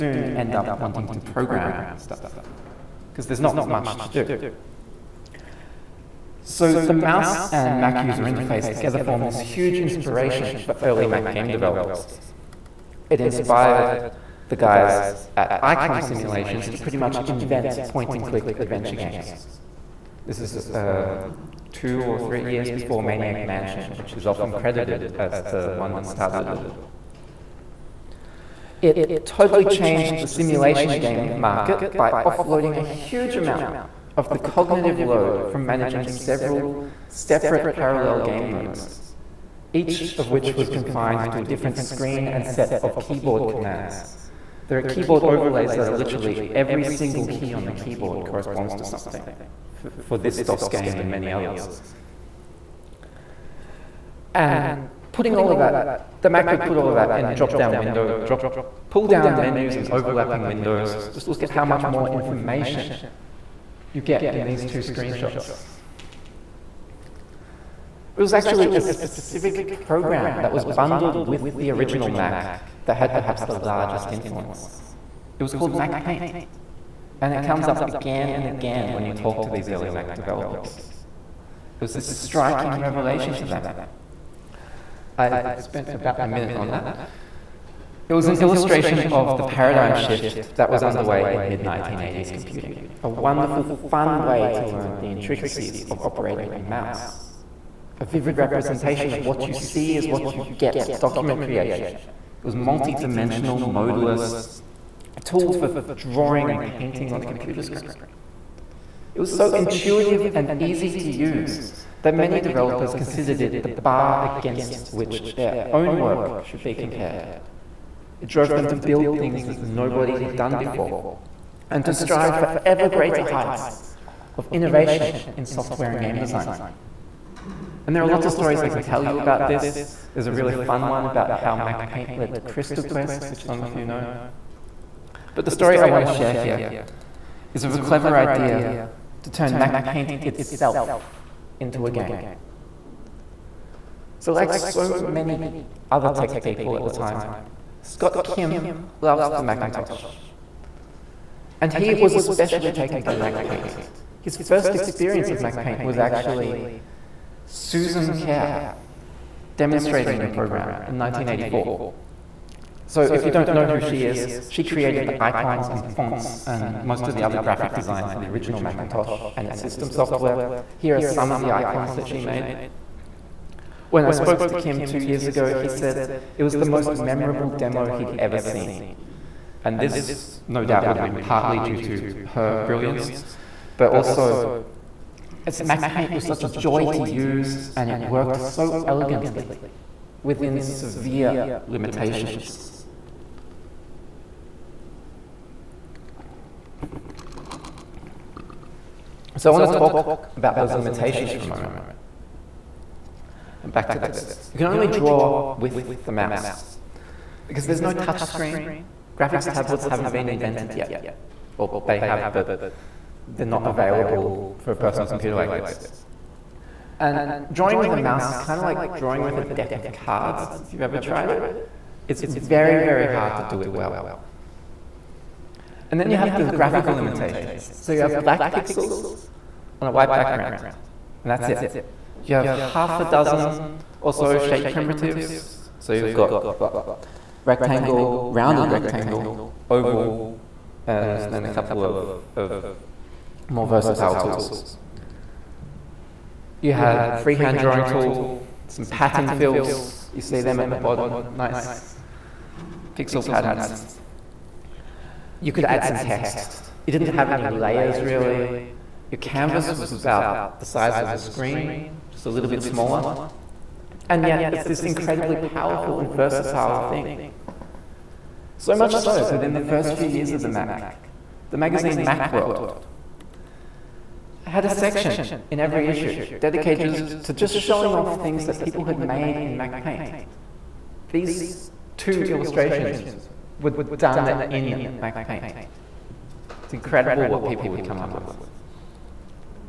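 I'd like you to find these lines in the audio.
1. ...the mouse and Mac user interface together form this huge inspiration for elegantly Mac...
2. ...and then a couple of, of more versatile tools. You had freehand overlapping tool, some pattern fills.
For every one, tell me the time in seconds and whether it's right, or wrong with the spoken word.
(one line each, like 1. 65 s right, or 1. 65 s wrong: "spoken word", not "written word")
1. 6 s wrong: "early", not "elegantly"
2. 240 s wrong: "drawing", not "overlapping".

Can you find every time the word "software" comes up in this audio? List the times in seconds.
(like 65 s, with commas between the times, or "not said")
125 s, 169 s.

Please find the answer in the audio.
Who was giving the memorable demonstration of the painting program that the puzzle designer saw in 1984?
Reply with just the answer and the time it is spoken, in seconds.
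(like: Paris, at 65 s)
Susan Kare, at 157 s.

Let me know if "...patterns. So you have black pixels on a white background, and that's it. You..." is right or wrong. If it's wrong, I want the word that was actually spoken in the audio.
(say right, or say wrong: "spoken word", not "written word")
wrong: "limitations", not "patterns".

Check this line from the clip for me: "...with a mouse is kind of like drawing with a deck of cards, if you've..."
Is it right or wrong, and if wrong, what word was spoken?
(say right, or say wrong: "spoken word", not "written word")
right.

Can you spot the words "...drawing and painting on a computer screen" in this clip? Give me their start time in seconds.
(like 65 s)
105 s.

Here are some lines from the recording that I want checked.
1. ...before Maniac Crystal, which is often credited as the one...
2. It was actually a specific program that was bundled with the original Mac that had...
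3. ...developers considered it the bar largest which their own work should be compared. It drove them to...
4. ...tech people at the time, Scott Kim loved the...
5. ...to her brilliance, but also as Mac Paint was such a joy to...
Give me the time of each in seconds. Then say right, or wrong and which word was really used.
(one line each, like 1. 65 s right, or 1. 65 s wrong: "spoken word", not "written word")
1. 22 s wrong: "Mansion", not "Crystal"
2. 68 s right
3. 112 s wrong: "against", not "largest"
4. 146 s right
5. 181 s right.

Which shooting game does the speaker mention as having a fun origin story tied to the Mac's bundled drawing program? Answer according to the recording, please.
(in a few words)
Crystal Quest.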